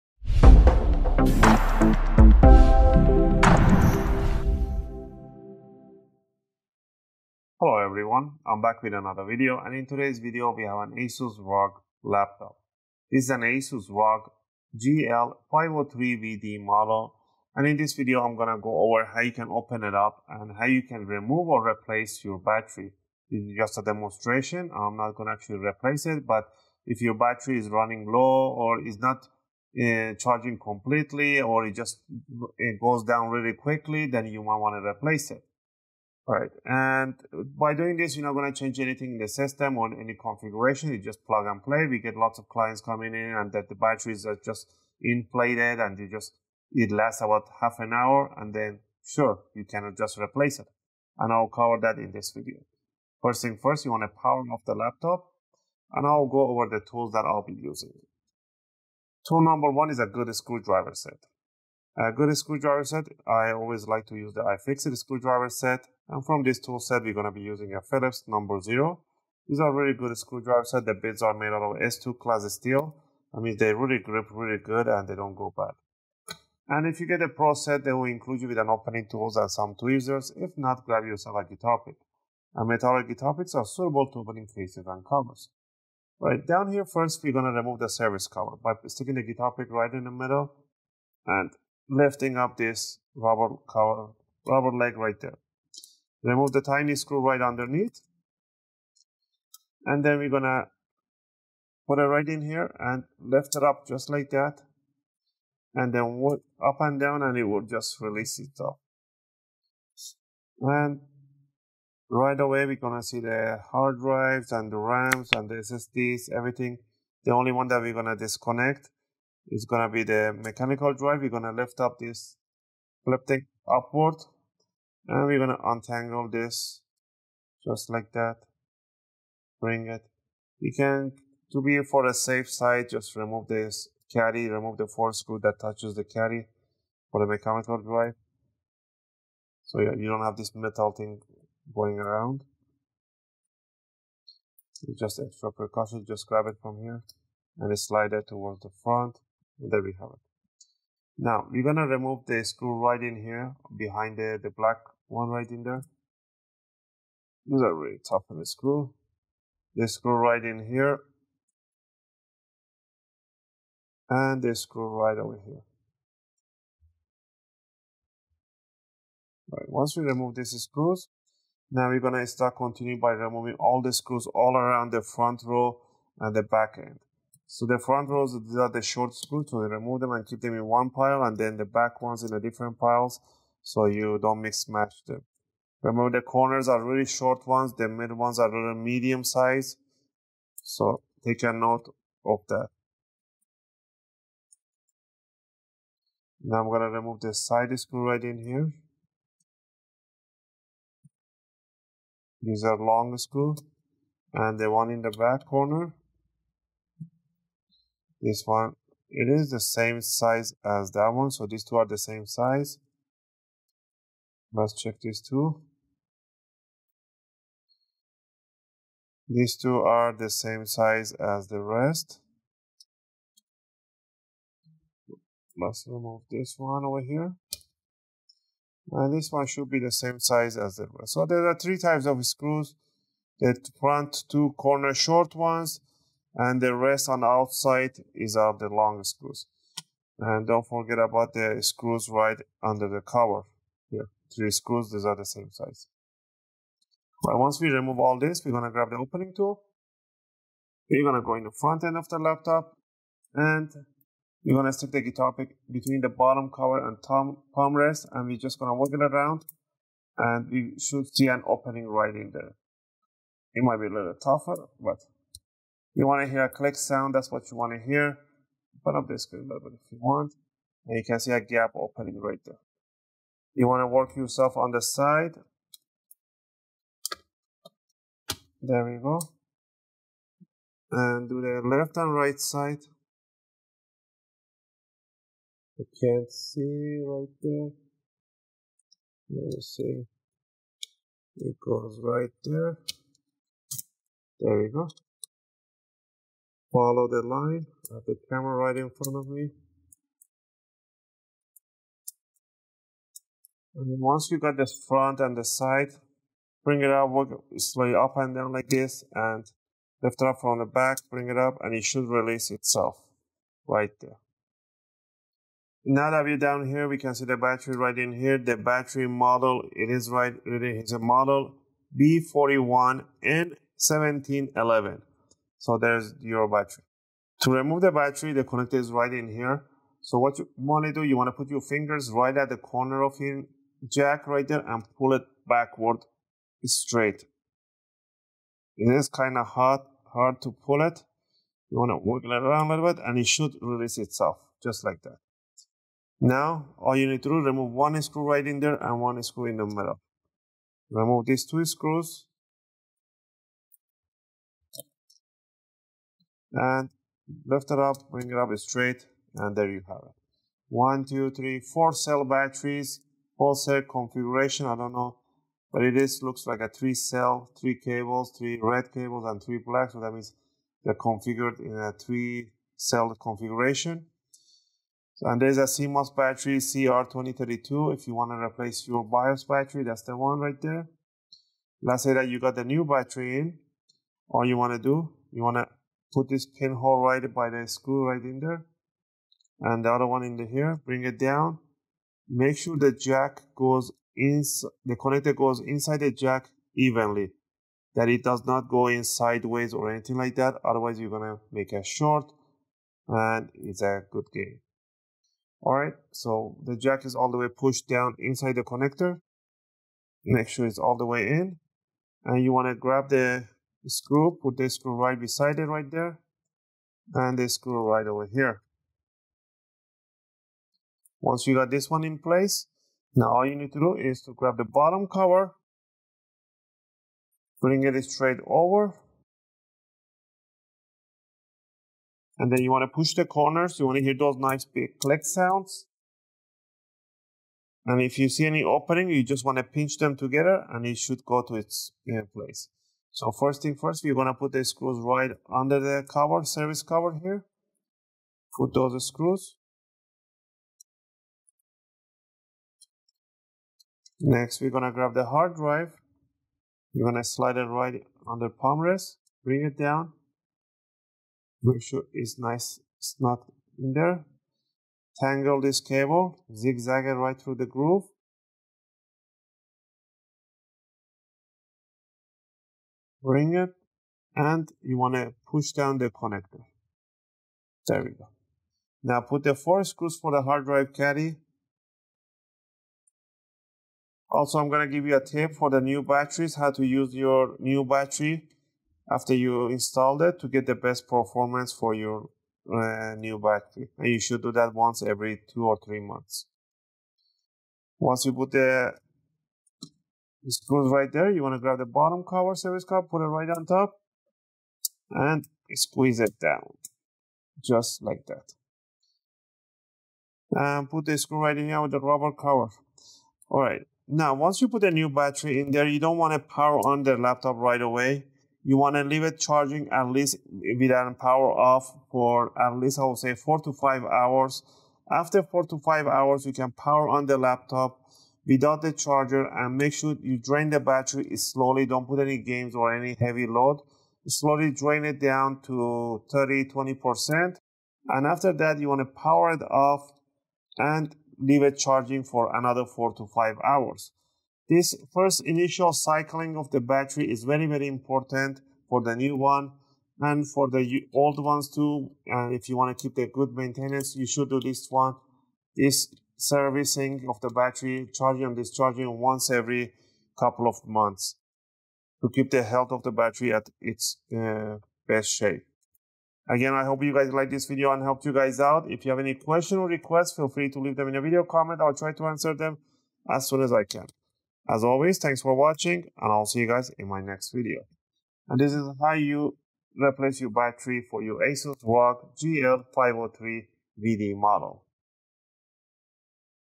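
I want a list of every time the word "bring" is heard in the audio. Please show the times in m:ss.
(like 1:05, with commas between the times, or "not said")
2:09, 5:06, 5:11, 5:58, 6:30, 7:07, 7:39, 7:53.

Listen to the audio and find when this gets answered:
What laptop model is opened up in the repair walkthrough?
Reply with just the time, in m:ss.
0:14.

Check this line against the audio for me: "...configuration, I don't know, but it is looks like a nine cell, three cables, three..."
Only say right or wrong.
wrong.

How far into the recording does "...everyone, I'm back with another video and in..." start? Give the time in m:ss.
0:07.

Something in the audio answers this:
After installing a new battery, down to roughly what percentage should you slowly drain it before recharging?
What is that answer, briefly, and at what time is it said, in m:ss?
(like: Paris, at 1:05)
30, 20%, at 8:56.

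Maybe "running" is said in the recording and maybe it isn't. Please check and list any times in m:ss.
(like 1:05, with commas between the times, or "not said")
0:27.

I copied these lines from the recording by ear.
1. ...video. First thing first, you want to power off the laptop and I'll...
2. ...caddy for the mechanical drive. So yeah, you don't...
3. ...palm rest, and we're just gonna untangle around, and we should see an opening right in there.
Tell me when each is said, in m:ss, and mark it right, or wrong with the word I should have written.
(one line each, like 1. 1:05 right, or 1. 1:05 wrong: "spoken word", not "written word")
1. 0:52 right
2. 2:16 right
3. 4:17 wrong: "wiggle", not "untangle".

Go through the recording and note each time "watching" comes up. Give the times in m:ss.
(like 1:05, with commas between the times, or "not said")
9:35.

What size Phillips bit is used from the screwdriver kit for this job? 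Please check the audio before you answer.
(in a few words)
number zero.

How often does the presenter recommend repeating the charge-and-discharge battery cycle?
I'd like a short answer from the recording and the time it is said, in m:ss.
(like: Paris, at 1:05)
once every two or three months, at 8:14.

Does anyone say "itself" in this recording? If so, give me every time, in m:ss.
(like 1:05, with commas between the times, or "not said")
1:48, 5:12, 5:43.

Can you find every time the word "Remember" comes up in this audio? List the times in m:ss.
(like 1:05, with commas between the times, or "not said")
3:05.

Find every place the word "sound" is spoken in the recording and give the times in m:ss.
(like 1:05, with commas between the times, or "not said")
4:26, 7:15.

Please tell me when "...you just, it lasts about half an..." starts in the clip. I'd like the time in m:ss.
0:45.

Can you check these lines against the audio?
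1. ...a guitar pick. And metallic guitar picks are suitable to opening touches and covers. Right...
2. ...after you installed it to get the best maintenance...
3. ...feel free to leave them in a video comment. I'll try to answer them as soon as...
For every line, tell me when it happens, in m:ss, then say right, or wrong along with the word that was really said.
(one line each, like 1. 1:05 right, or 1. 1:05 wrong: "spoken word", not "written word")
1. 1:21 wrong: "cases", not "touches"
2. 8:09 wrong: "performance", not "maintenance"
3. 9:30 right.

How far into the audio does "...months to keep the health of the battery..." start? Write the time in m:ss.
9:20.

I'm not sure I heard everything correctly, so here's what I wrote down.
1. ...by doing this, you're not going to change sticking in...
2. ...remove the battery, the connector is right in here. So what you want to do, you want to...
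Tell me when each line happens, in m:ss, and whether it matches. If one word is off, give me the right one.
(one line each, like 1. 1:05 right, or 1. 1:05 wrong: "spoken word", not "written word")
1. 0:37 wrong: "anything", not "sticking"
2. 5:27 right.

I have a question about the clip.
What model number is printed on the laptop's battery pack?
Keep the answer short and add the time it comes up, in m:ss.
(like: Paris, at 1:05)
B41N1711, at 5:21.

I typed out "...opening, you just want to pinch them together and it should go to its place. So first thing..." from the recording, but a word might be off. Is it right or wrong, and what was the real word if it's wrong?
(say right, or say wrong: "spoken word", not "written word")
right.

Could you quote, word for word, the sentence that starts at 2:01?
We're gonna lift up this, flip upward, and we're gonna untangle this just like that.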